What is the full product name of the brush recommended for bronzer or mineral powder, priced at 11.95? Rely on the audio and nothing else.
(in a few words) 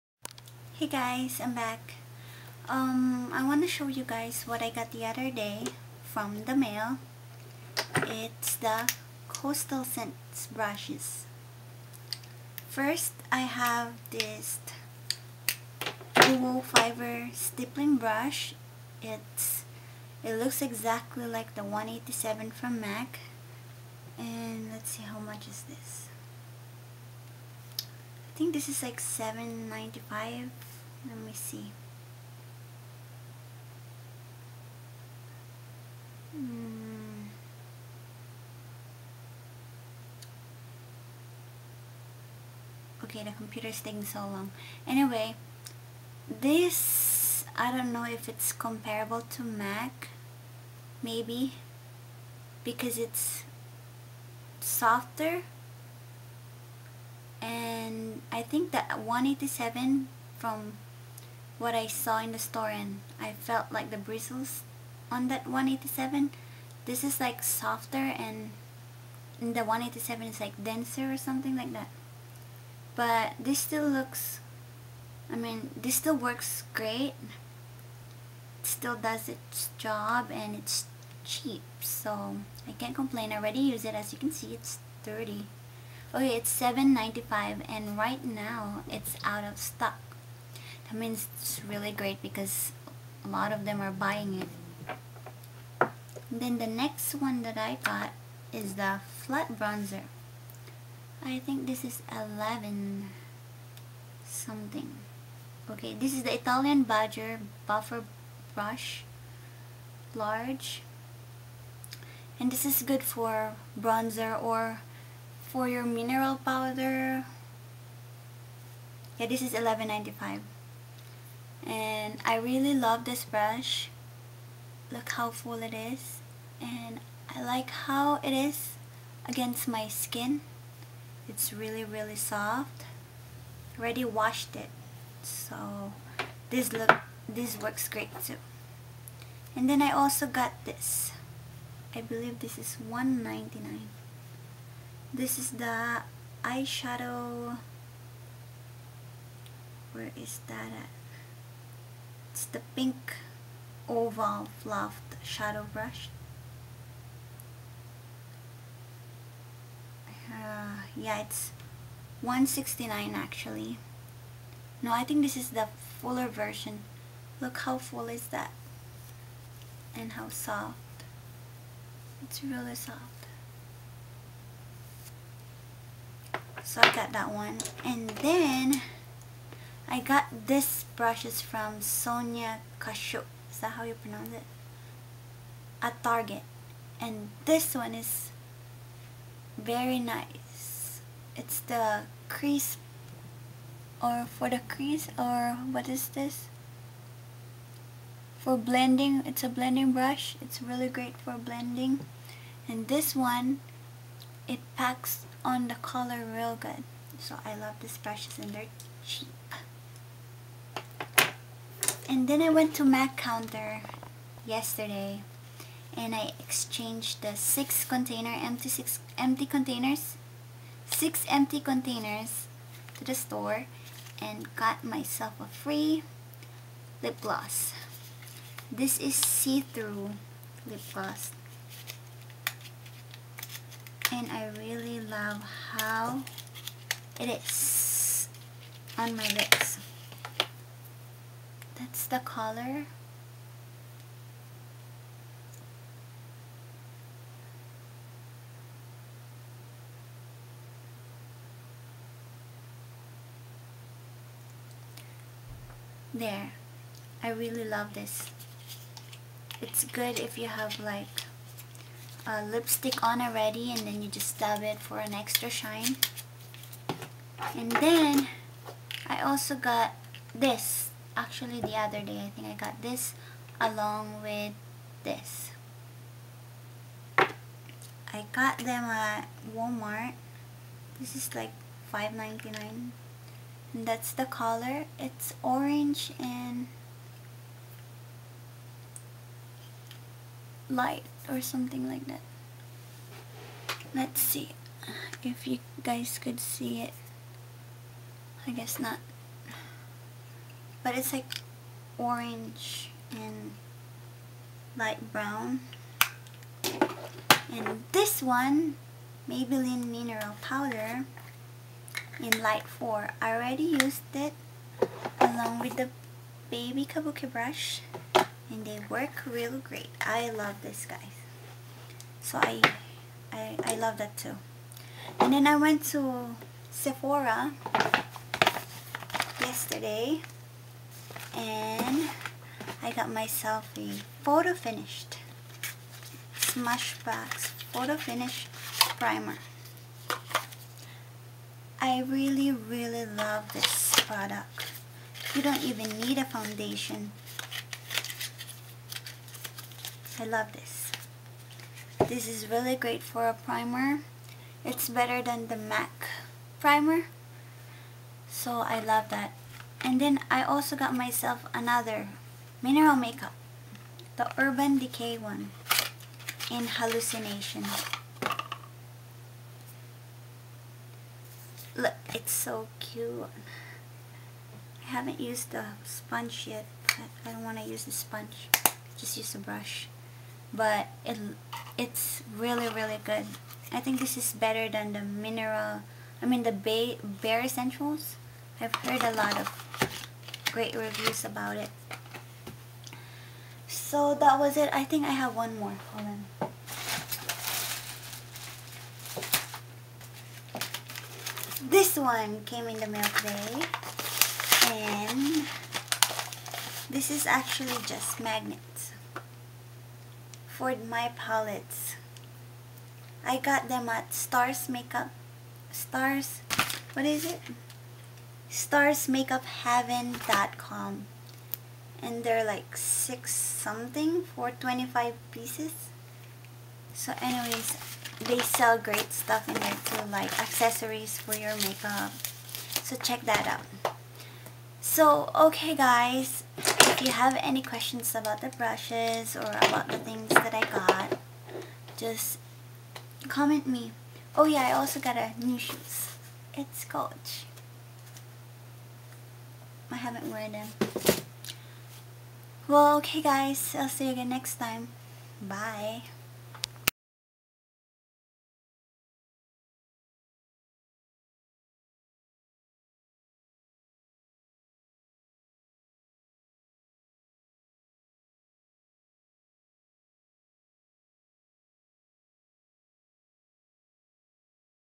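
Italian Badger Buffer Brush Large.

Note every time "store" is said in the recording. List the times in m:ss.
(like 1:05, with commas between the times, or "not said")
1:02, 3:43.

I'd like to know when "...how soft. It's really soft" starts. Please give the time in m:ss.
2:50.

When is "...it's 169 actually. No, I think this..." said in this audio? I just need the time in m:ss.
2:41.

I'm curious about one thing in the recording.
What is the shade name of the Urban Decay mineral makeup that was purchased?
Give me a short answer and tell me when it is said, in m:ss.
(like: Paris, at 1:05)
Hallucination, at 6:06.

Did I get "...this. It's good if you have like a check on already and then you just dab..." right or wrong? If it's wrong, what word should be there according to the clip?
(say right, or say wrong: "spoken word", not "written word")
wrong: "lipstick", not "check".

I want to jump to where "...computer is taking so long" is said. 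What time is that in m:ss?
0:43.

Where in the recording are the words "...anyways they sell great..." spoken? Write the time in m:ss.
7:07.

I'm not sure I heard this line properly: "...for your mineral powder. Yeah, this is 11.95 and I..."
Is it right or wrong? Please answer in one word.
right.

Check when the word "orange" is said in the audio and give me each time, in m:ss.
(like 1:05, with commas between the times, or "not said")
4:45, 5:01.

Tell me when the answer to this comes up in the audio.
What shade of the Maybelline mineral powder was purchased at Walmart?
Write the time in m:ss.
5:12.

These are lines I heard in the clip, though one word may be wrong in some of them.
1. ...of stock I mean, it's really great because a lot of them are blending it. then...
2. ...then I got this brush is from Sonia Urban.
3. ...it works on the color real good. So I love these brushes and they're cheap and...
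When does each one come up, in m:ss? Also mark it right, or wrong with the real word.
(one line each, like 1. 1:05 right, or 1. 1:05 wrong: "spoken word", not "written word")
1. 1:29 wrong: "buying", not "blending"
2. 2:58 wrong: "Kashuk", not "Urban"
3. 3:24 wrong: "packs", not "works".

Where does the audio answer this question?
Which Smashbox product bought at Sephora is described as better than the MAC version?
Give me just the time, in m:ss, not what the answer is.
5:37.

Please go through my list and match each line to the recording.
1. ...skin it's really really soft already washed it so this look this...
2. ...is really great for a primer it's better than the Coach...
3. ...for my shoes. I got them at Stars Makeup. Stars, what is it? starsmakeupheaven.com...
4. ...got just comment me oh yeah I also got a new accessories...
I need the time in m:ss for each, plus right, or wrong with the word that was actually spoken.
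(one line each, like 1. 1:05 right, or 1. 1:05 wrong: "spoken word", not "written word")
1. 2:09 right
2. 5:52 wrong: "MAC", not "Coach"
3. 6:50 wrong: "palettes", not "shoes"
4. 7:20 wrong: "shoes", not "accessories".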